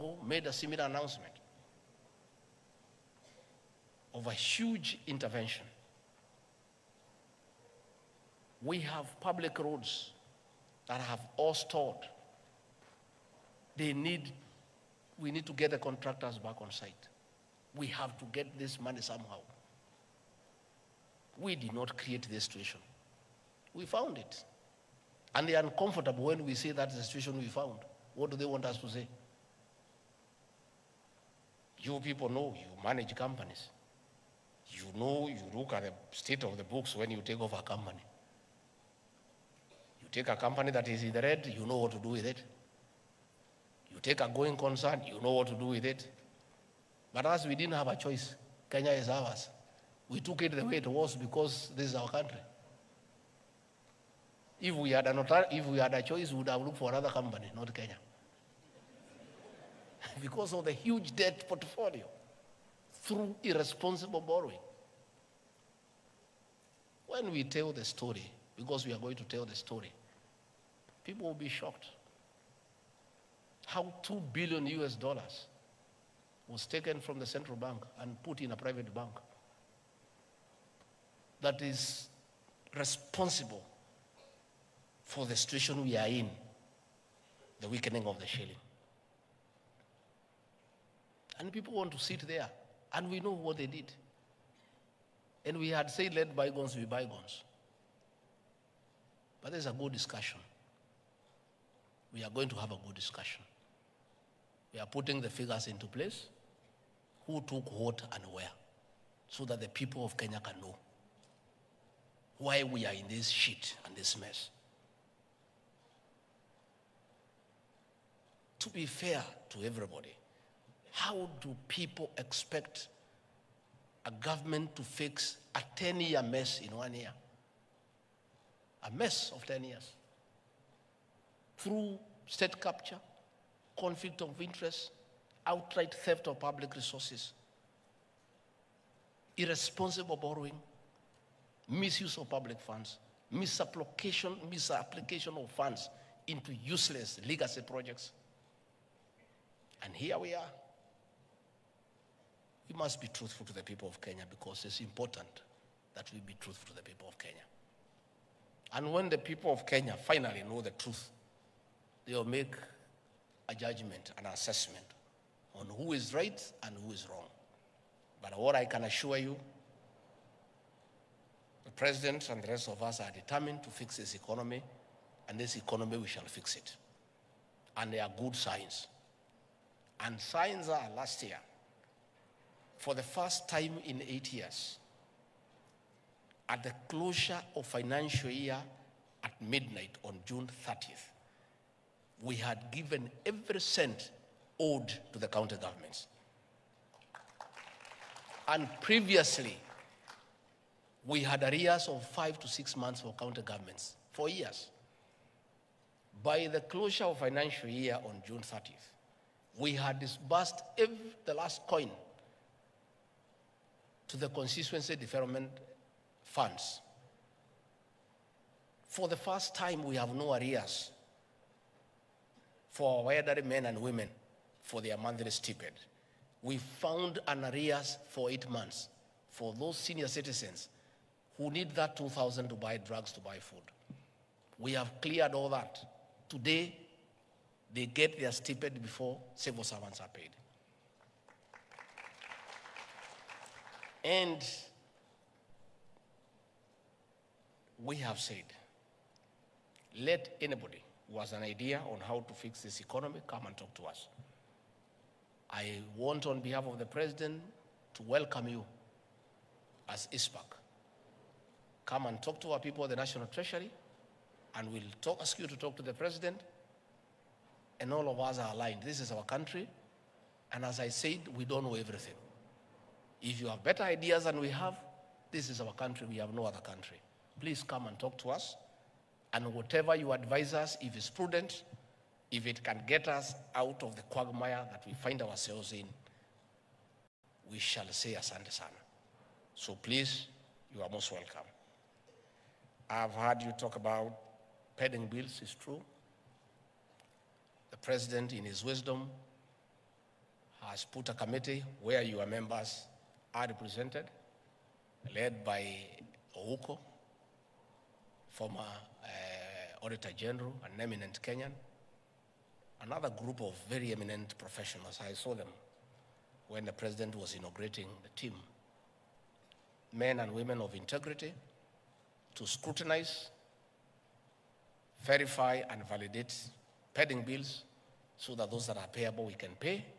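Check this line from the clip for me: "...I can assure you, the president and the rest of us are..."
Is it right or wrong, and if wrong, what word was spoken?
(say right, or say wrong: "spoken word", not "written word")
right.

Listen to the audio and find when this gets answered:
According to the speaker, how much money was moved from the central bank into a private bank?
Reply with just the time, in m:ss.
1:14.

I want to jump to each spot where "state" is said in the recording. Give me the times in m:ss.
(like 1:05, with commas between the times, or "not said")
0:36, 2:12.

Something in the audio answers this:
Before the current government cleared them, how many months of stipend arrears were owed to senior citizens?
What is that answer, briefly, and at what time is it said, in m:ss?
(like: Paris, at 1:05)
8 months, at 3:48.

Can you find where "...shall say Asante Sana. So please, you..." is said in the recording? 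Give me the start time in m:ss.
4:47.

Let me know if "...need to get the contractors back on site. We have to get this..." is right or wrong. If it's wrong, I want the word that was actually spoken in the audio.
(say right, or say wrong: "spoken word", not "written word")
right.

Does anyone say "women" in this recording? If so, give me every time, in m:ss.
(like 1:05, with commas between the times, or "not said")
3:43, 5:20.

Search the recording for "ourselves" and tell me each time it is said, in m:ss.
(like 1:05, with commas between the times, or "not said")
4:45.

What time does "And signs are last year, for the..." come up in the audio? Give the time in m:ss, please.
3:00.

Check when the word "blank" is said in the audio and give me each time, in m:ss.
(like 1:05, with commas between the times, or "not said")
not said.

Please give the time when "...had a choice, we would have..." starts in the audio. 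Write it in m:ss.
0:55.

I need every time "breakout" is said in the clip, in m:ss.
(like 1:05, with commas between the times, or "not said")
not said.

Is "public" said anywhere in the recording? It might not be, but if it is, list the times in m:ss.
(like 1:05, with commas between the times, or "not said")
0:09, 2:16, 2:22.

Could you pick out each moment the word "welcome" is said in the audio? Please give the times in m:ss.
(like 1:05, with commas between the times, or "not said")
4:18, 4:51.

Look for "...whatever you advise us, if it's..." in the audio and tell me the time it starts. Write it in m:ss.
4:39.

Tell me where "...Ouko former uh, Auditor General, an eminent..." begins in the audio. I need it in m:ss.
5:06.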